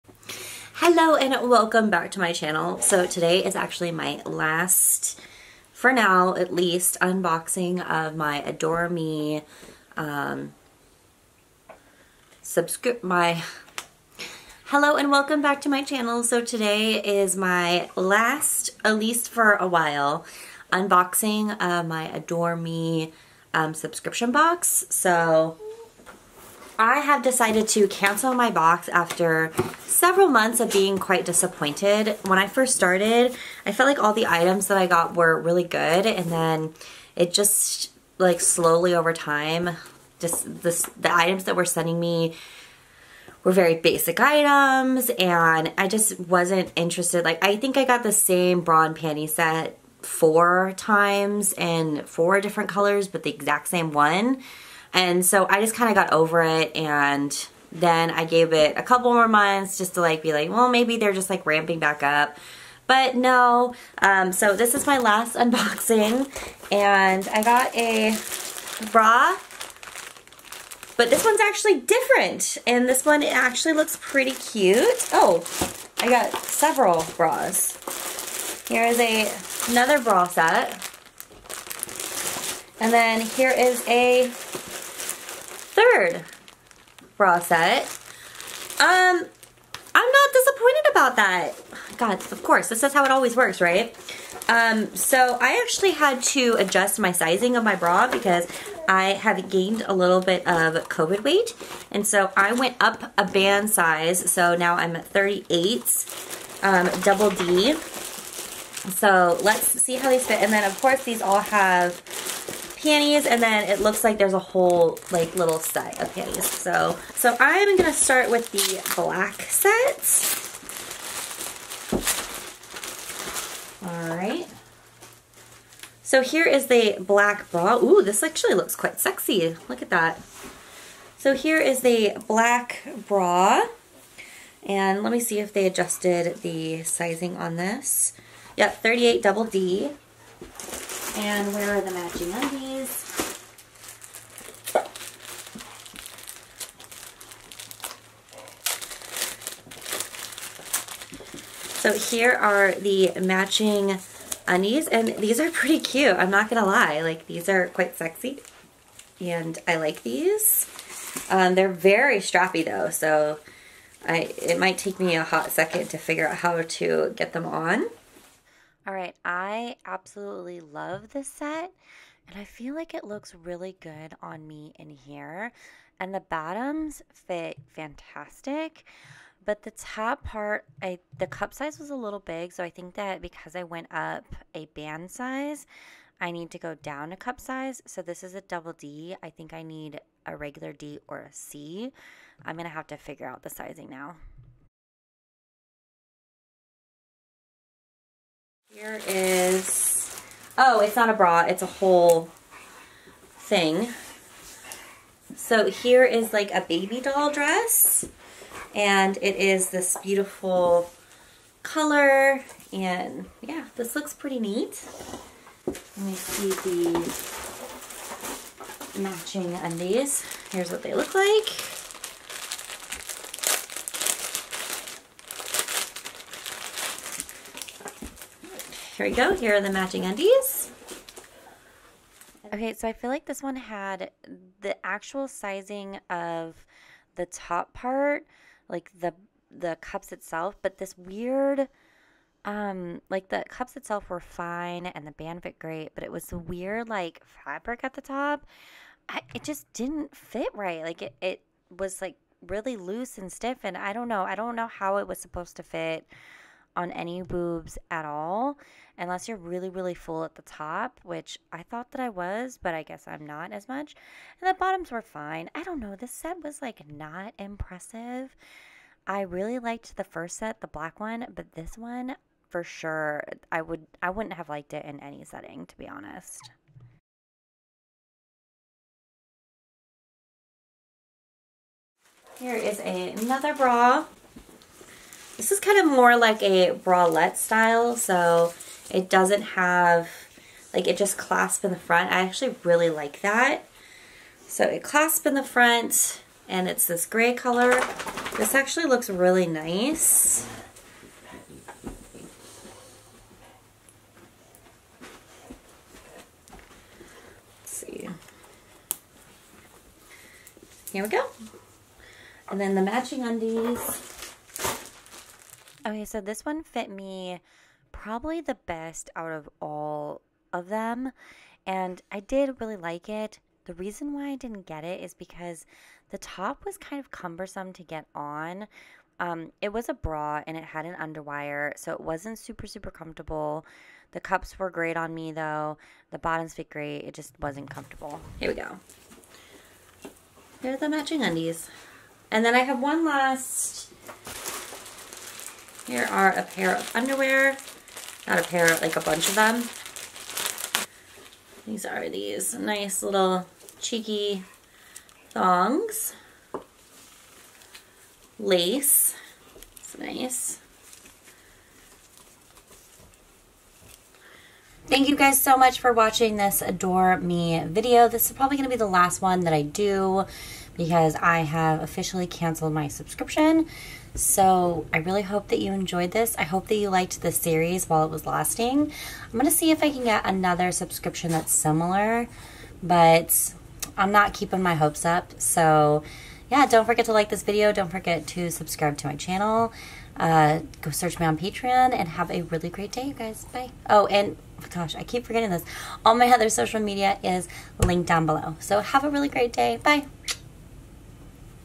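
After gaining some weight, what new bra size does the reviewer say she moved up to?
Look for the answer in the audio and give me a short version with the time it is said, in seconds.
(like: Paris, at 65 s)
38 DD, at 105 s.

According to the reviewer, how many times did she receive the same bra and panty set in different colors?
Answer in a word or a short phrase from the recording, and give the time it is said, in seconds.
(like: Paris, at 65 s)
4, at 50 s.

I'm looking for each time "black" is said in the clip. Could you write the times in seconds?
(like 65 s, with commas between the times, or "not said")
118 s, 126 s, 132 s, 270 s.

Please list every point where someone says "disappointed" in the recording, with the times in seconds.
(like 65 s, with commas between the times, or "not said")
31 s, 90 s.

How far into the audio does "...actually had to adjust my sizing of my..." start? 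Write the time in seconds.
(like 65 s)
95 s.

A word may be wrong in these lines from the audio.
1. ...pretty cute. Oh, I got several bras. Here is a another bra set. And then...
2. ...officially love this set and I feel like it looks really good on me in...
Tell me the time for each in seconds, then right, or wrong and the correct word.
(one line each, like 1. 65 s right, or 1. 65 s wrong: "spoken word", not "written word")
1. 74 s right
2. 169 s wrong: "absolutely", not "officially".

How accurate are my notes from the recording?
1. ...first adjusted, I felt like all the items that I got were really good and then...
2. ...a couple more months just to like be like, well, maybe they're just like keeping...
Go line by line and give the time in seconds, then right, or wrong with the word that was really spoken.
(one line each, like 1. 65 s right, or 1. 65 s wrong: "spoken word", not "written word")
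1. 32 s wrong: "started", not "adjusted"
2. 58 s wrong: "ramping", not "keeping".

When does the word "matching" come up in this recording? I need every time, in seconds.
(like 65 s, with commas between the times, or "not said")
141 s, 153 s, 218 s, 229 s, 312 s, 340 s.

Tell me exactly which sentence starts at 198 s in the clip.
Here is, oh, it's not a bra, it's a whole thing.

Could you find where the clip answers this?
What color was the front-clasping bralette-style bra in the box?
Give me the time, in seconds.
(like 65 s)
297 s.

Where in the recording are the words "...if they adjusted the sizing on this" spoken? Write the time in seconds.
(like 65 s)
135 s.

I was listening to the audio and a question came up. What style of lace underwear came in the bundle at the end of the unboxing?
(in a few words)
cheeky thongs.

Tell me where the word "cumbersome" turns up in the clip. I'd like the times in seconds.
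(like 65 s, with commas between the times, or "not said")
327 s.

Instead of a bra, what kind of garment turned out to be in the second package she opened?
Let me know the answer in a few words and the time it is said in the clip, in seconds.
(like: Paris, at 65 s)
baby doll dress, at 206 s.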